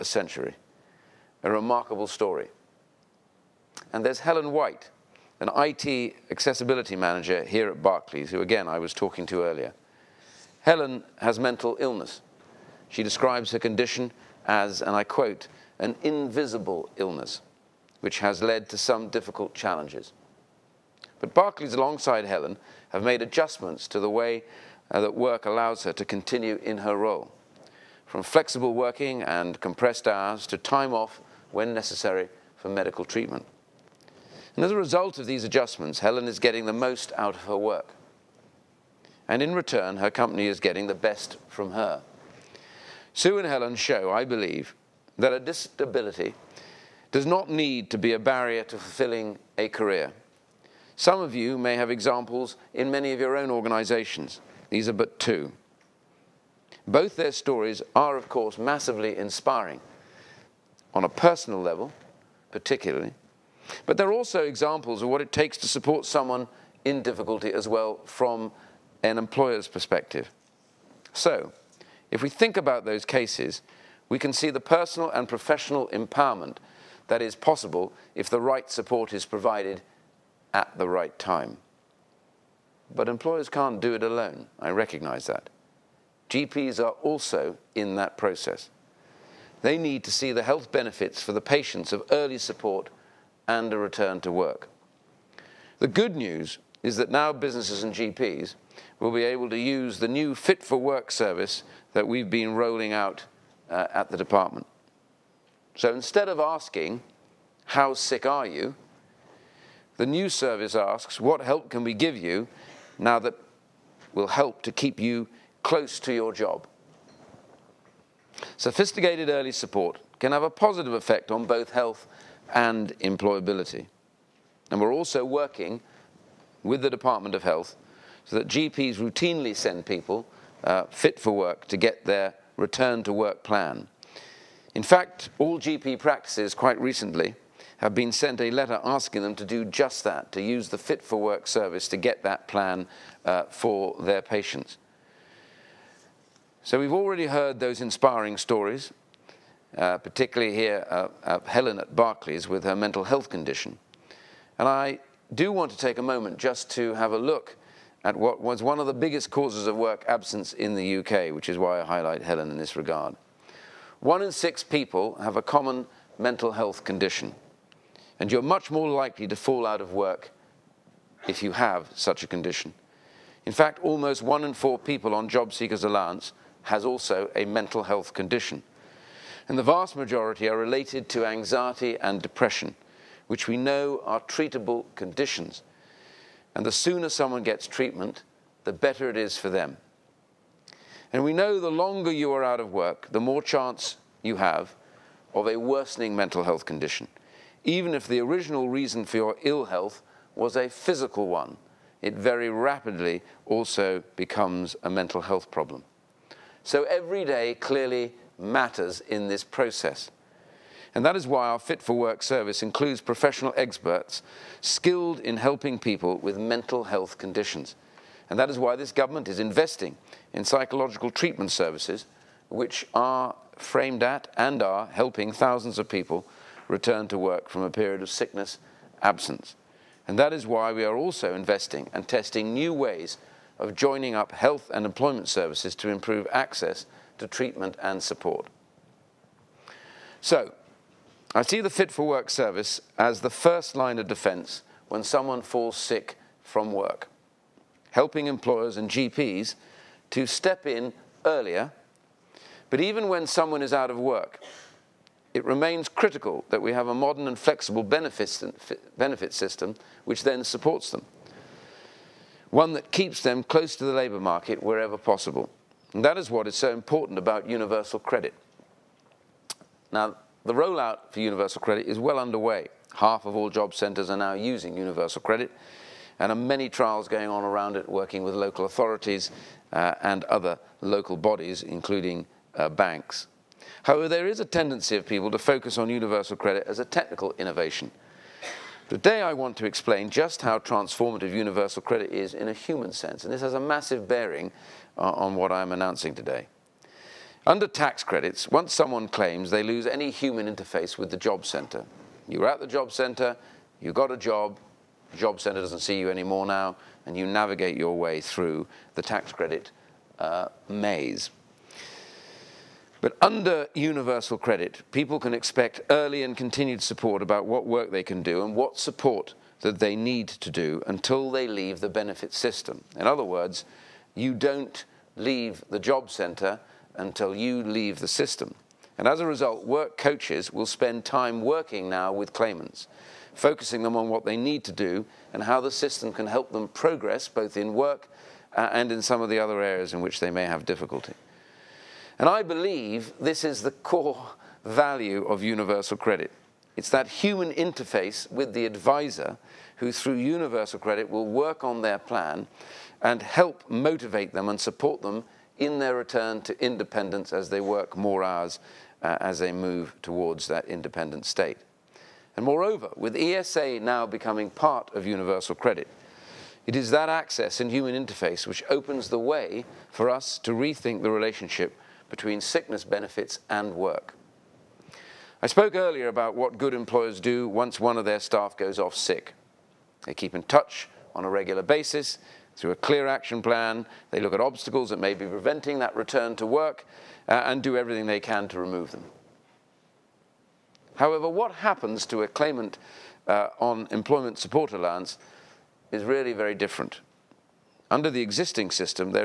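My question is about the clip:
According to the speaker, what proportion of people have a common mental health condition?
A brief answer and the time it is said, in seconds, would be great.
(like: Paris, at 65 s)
One in six, at 163 s.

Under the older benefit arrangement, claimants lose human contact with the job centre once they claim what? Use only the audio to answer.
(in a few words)
Tax credits.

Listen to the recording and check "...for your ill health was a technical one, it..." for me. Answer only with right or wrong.
wrong.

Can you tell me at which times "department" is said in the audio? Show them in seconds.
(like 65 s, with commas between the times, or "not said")
104 s, 126 s.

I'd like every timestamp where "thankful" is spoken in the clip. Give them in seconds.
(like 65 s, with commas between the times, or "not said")
not said.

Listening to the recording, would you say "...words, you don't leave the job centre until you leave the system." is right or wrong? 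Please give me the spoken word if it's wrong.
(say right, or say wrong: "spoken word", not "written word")
right.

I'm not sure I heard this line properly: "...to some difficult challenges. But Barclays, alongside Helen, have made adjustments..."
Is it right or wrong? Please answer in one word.
right.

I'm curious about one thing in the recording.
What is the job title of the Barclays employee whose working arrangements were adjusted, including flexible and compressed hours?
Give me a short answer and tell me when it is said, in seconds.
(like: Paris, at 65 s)
IT accessibility manager, at 5 s.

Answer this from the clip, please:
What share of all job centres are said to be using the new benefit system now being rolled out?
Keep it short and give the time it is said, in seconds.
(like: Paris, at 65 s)
Half, at 272 s.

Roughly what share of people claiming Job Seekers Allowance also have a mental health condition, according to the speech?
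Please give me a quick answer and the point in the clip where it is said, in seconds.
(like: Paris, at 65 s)
One in four, at 174 s.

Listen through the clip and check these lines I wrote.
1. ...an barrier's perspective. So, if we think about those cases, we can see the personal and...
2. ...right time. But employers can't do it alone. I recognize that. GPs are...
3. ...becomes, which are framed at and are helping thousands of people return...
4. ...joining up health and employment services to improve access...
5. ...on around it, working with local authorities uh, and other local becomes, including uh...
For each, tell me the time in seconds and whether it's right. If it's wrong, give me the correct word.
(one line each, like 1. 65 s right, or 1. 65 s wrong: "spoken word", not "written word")
1. 69 s wrong: "employer", not "barrier"
2. 80 s right
3. 221 s wrong: "services", not "becomes"
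4. 233 s right
5. 277 s wrong: "bodies", not "becomes".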